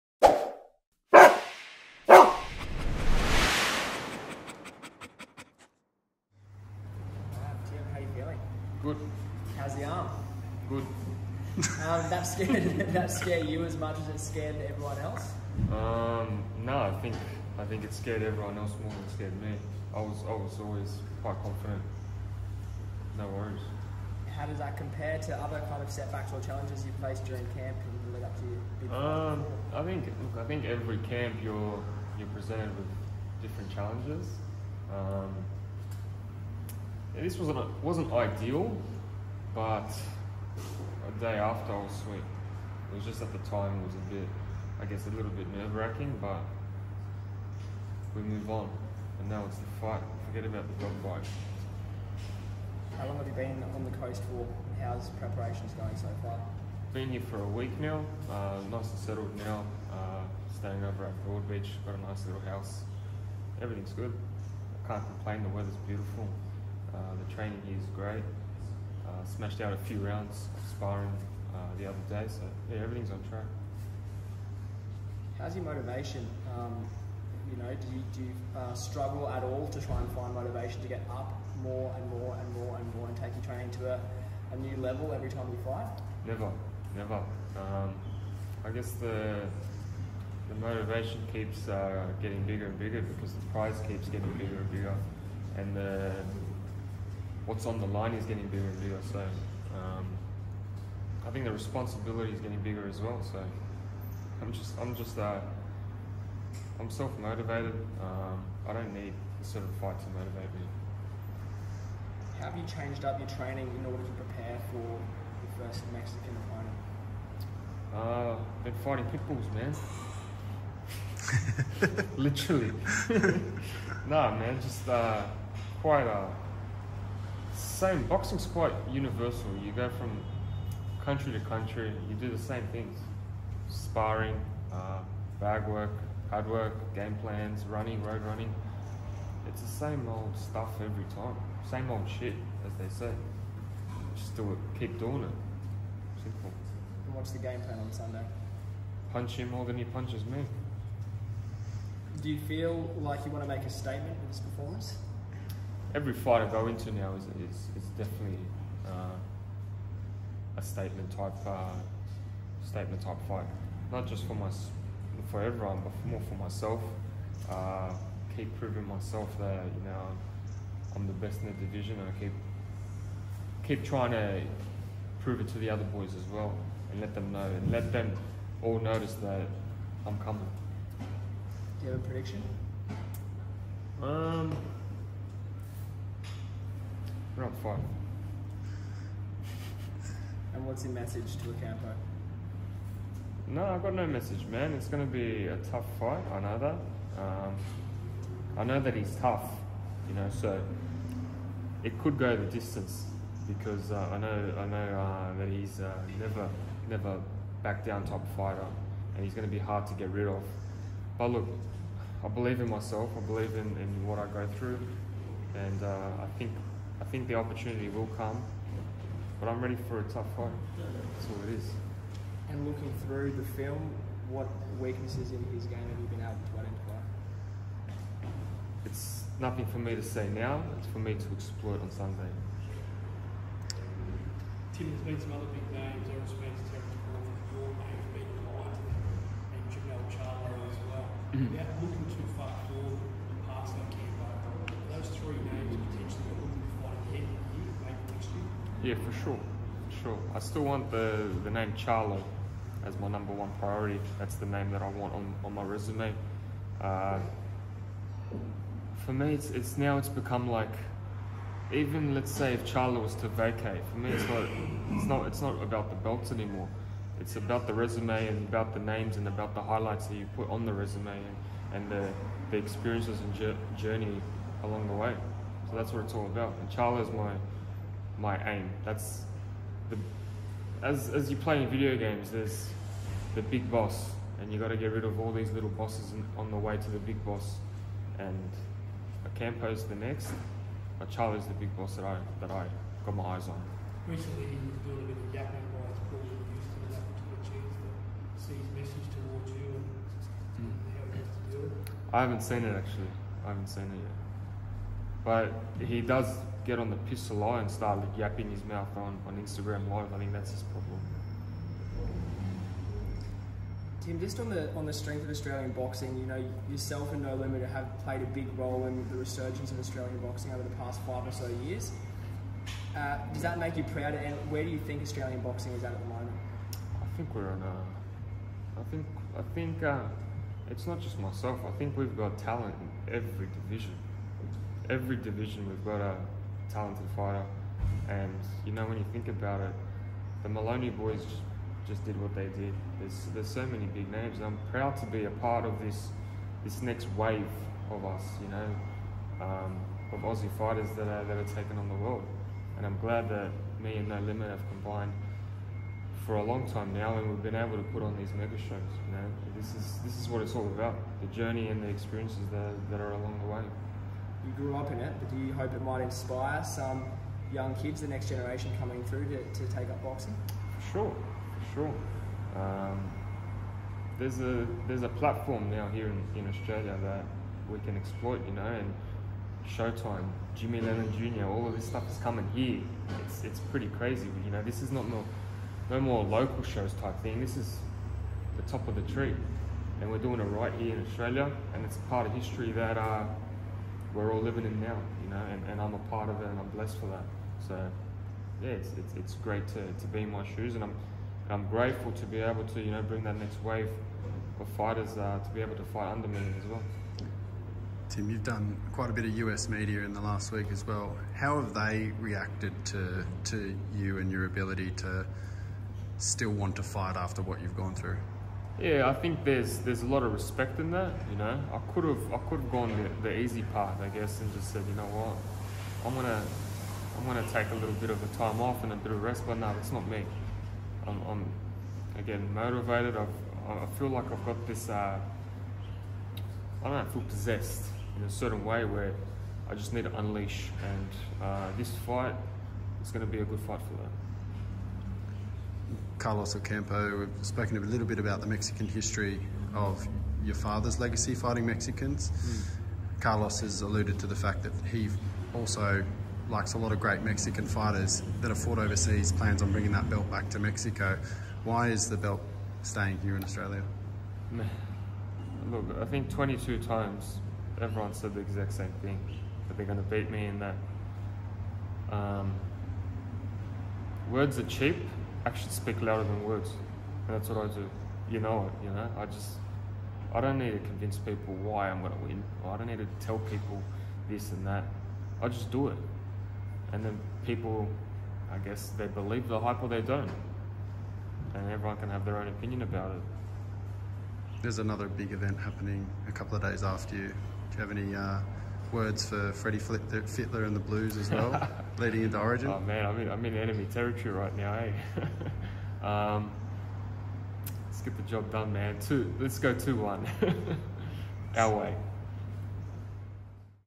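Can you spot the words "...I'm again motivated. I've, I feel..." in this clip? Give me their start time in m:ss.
7:11.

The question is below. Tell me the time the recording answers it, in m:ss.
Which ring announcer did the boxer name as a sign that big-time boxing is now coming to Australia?
6:20.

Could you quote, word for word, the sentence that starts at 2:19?
It's the same old stuff every time.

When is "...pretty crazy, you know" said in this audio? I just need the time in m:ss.
6:23.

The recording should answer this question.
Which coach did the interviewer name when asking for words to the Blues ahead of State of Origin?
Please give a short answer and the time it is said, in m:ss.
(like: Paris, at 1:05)
Freddie Fittler, at 8:19.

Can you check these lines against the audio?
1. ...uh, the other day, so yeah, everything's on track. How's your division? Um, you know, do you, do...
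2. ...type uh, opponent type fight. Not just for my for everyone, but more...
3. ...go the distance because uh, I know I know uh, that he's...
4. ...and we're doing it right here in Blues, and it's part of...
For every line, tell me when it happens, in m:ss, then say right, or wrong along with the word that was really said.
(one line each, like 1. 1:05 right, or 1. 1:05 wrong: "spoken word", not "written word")
1. 1:11 wrong: "motivation", not "division"
2. 2:41 wrong: "statement", not "opponent"
3. 3:22 right
4. 6:30 wrong: "Australia", not "Blues".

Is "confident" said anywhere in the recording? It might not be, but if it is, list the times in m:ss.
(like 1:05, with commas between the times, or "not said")
0:21.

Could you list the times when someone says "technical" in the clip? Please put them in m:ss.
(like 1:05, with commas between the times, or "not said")
3:56.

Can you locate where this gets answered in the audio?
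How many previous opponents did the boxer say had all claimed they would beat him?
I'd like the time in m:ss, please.
7:46.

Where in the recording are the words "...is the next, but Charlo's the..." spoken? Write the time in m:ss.
4:49.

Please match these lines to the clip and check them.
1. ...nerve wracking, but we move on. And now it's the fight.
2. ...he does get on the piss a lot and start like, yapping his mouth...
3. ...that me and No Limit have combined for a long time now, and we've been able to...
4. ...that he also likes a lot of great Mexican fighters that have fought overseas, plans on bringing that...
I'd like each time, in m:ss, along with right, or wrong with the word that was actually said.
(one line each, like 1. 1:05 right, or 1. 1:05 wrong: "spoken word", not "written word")
1. 0:45 right
2. 5:05 right
3. 5:53 right
4. 7:34 right.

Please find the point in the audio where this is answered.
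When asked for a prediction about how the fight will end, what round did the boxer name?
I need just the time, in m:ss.
3:07.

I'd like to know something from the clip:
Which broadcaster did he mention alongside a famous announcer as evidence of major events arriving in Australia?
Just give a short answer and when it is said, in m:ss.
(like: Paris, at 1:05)
Showtime, at 6:19.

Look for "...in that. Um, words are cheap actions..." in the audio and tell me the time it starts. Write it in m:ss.
7:50.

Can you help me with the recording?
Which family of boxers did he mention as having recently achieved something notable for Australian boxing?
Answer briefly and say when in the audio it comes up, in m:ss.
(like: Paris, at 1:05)
The Moloney boys, at 5:40.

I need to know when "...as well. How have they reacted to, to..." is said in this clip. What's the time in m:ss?
6:50.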